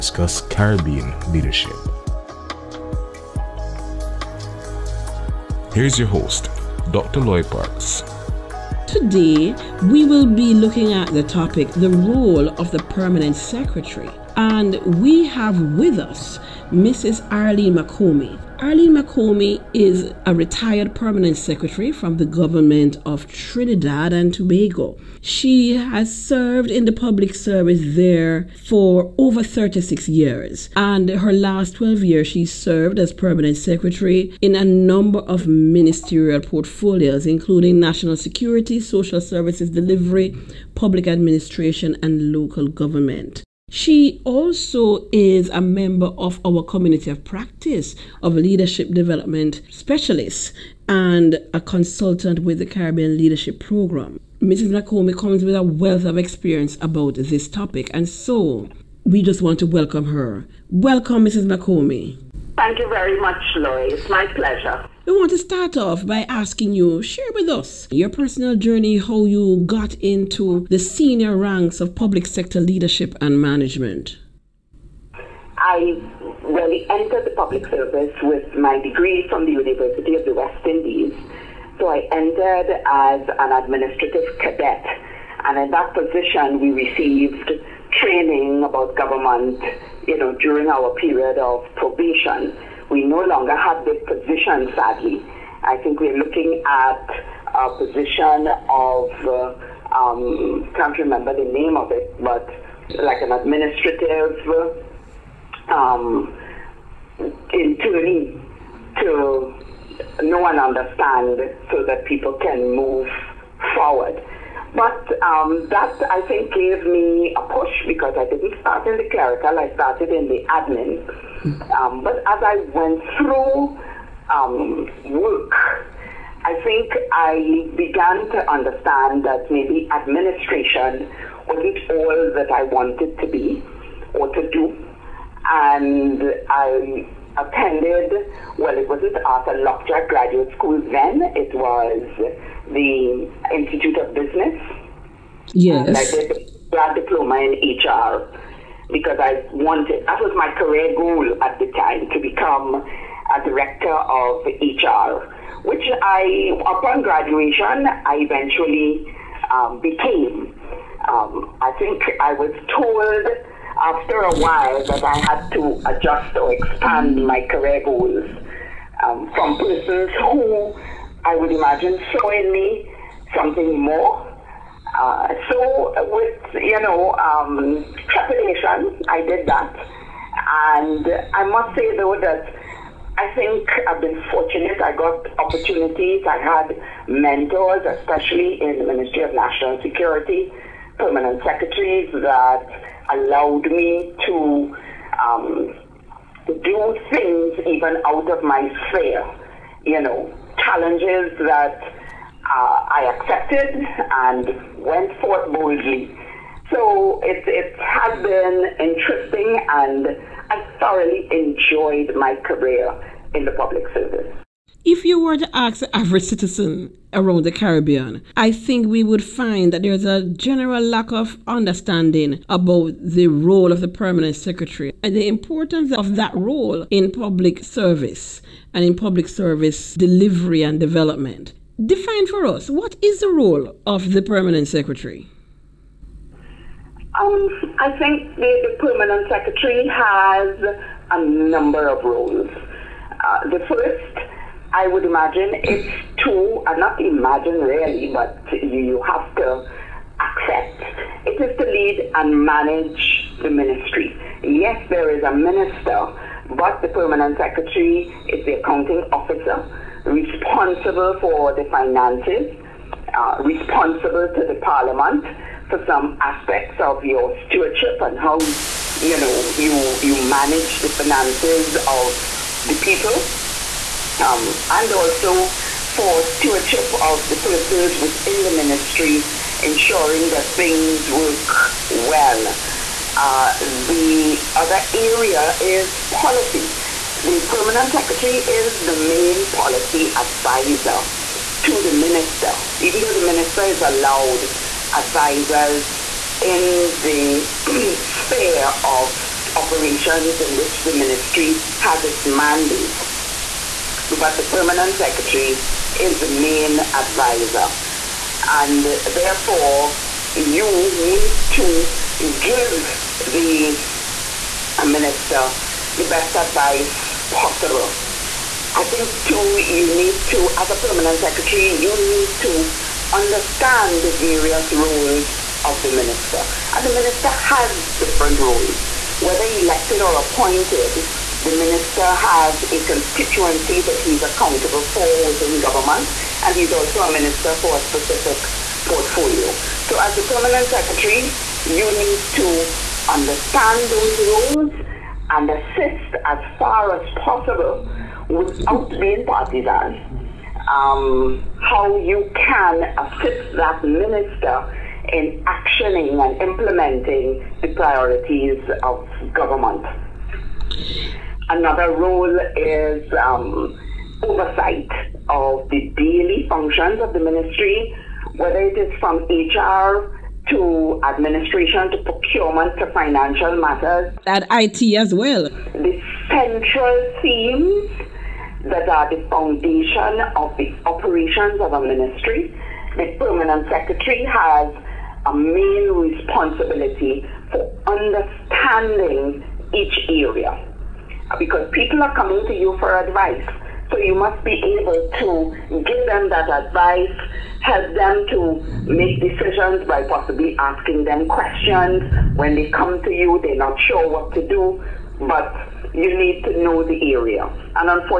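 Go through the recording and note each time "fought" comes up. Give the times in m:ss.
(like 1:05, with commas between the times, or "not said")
not said.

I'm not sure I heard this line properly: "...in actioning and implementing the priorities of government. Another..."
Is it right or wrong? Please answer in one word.
right.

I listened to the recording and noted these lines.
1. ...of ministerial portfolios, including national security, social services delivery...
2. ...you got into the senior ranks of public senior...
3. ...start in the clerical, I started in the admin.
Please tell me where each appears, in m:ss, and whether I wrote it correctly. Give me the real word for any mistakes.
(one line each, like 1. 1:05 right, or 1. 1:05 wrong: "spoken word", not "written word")
1. 0:35 right
2. 1:09 wrong: "sector", not "senior"
3. 1:58 right.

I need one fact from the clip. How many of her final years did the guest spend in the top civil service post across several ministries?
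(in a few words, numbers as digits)
12.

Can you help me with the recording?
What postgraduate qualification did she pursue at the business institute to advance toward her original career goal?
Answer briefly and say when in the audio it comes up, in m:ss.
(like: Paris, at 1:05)
grad diploma in HR, at 2:26.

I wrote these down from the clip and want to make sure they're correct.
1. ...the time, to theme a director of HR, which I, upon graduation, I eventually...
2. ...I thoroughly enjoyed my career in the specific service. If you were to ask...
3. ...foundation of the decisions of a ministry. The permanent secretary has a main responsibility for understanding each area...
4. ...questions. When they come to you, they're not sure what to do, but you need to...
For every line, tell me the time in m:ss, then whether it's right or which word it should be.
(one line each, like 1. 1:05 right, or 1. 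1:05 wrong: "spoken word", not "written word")
1. 2:31 wrong: "become", not "theme"
2. 3:30 wrong: "public", not "specific"
3. 6:19 wrong: "operations", not "decisions"
4. 6:41 right.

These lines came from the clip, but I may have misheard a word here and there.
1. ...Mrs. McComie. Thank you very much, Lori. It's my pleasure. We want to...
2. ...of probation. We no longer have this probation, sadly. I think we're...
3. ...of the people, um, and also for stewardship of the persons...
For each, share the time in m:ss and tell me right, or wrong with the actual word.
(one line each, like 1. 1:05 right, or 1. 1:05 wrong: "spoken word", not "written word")
1. 1:01 right
2. 1:31 wrong: "position", not "probation"
3. 4:31 right.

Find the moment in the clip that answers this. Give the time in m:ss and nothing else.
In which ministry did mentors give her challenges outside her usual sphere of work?
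3:08.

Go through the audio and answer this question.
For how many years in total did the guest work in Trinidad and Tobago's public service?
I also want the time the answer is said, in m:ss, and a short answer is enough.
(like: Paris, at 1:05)
36, at 0:29.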